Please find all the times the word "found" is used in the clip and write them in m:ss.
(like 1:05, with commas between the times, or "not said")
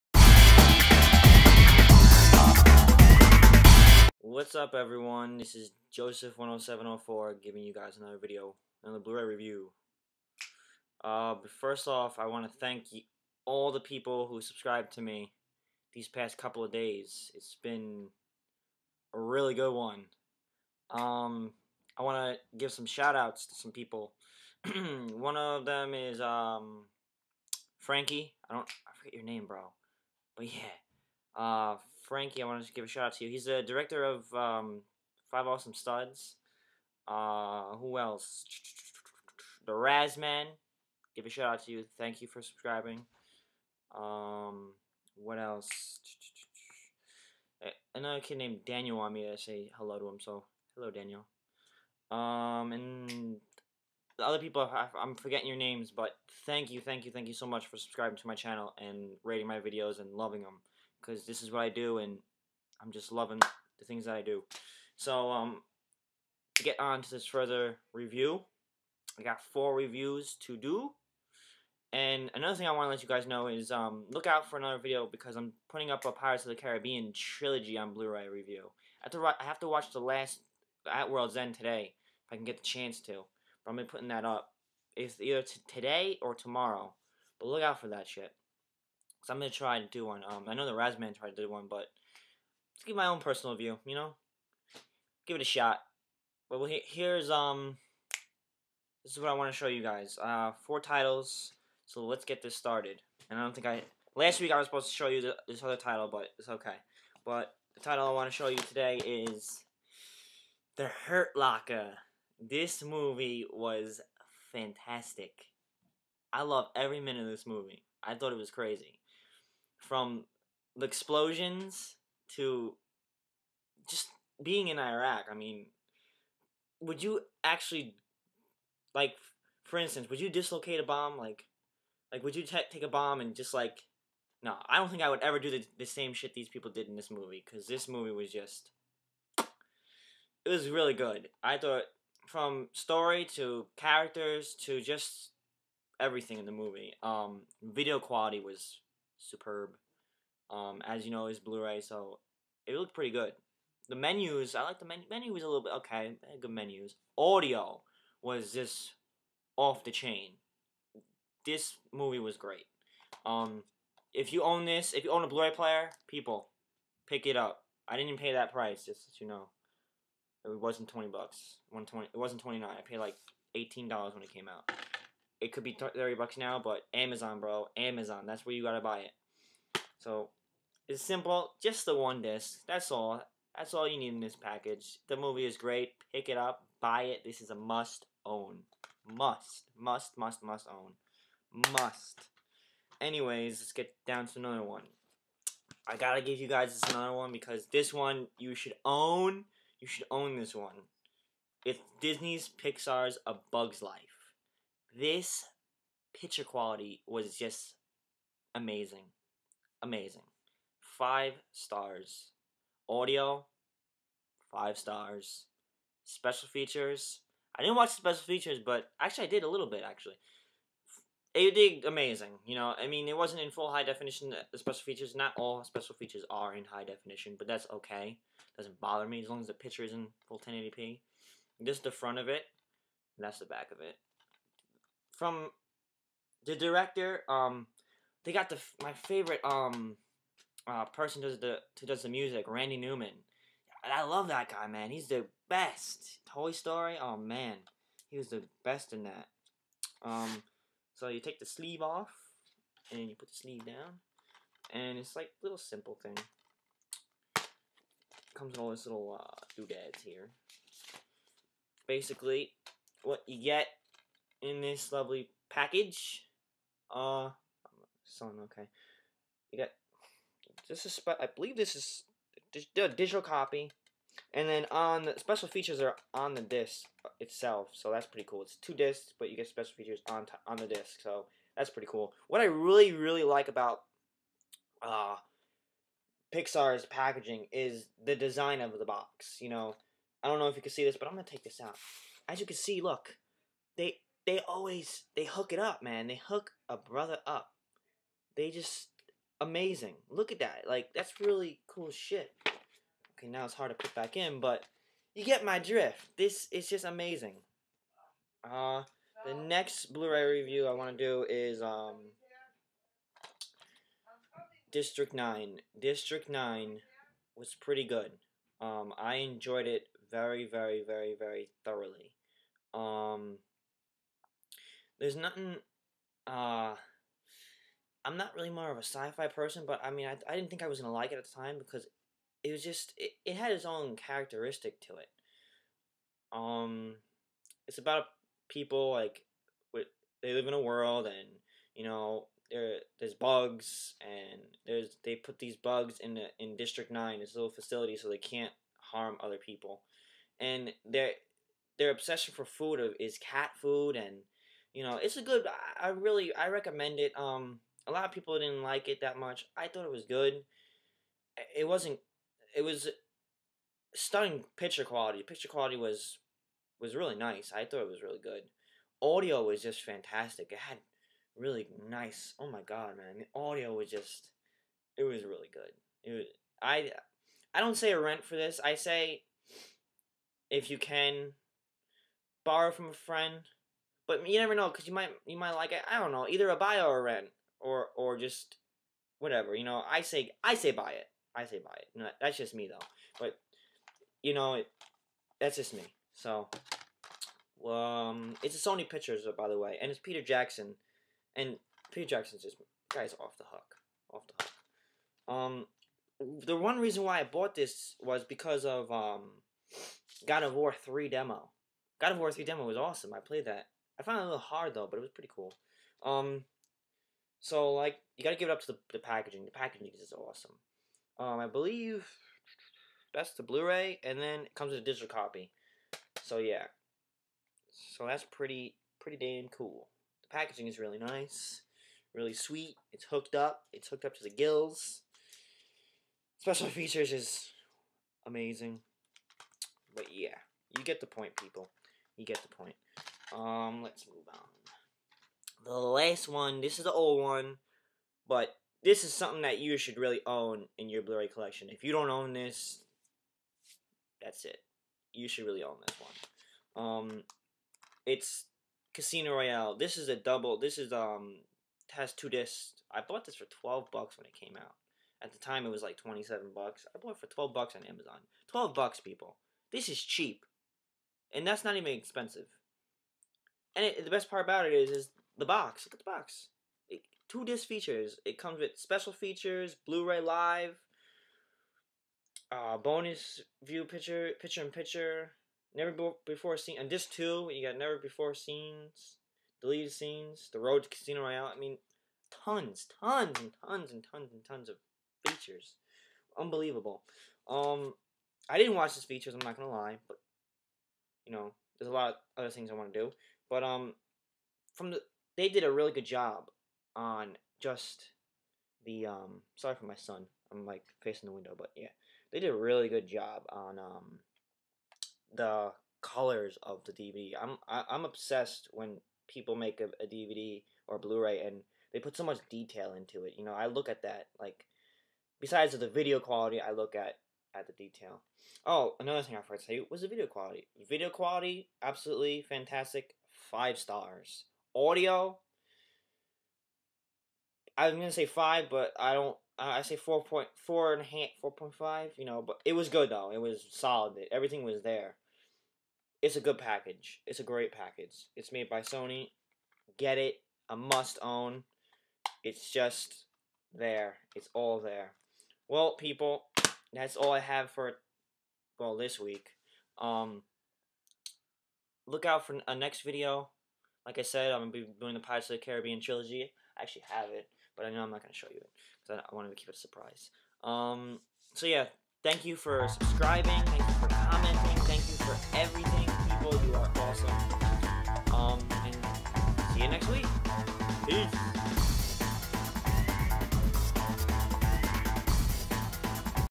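6:54.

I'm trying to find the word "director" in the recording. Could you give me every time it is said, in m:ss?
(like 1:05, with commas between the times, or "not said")
0:33, 3:56.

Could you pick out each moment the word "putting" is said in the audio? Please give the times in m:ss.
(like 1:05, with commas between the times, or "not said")
1:15, 1:23.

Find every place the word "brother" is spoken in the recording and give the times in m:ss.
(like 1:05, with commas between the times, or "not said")
4:56.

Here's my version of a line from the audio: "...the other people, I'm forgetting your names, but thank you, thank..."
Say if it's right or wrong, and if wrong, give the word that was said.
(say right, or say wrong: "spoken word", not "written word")
right.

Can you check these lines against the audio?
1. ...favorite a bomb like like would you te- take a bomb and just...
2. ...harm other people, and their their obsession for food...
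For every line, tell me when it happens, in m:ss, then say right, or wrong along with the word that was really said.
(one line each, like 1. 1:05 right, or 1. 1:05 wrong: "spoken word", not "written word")
1. 2:10 wrong: "dislocate", not "favorite"
2. 5:48 right.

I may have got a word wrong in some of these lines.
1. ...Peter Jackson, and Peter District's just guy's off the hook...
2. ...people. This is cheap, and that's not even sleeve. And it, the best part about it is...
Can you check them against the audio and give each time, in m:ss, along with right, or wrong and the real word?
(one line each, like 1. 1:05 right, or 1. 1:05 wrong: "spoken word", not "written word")
1. 6:40 wrong: "Jackson", not "District"
2. 7:49 wrong: "expensive", not "sleeve".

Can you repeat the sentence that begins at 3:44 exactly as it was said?
Uh, the special features, not all special features are in high definition, but that's okay.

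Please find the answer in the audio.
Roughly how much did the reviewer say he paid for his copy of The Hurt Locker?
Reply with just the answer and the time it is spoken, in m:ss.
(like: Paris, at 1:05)
$18, at 2:53.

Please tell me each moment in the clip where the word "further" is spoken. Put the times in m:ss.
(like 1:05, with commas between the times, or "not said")
1:07.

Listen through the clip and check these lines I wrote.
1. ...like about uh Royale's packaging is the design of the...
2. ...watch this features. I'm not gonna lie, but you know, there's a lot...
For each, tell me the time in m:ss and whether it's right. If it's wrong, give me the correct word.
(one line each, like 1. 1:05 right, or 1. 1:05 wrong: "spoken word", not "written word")
1. 4:43 wrong: "Pixar", not "Royale"
2. 8:18 right.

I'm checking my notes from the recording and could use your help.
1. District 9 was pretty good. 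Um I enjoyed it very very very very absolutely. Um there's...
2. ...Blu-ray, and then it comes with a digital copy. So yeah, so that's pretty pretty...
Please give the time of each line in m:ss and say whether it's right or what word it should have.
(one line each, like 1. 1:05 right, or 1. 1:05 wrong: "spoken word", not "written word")
1. 5:15 wrong: "thoroughly", not "absolutely"
2. 7:03 right.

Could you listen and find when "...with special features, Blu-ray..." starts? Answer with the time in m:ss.
7:58.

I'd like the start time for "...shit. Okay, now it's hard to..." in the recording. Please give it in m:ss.
5:01.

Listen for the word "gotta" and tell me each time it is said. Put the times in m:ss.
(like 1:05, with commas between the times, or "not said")
2:58, 3:15.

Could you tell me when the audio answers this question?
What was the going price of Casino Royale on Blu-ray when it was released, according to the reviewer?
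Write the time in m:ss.
7:45.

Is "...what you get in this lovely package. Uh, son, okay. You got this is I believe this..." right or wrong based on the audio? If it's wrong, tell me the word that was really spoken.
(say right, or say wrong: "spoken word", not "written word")
right.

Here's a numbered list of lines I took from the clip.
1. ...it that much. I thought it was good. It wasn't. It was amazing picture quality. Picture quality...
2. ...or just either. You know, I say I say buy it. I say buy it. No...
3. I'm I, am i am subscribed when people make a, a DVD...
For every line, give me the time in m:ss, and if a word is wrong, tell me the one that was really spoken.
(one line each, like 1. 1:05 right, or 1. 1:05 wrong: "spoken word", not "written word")
1. 5:58 wrong: "stunning", not "amazing"
2. 6:27 wrong: "whatever", not "either"
3. 8:37 wrong: "obsessed", not "subscribed".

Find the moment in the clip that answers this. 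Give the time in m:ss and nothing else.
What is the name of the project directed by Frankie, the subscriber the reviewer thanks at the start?
0:35.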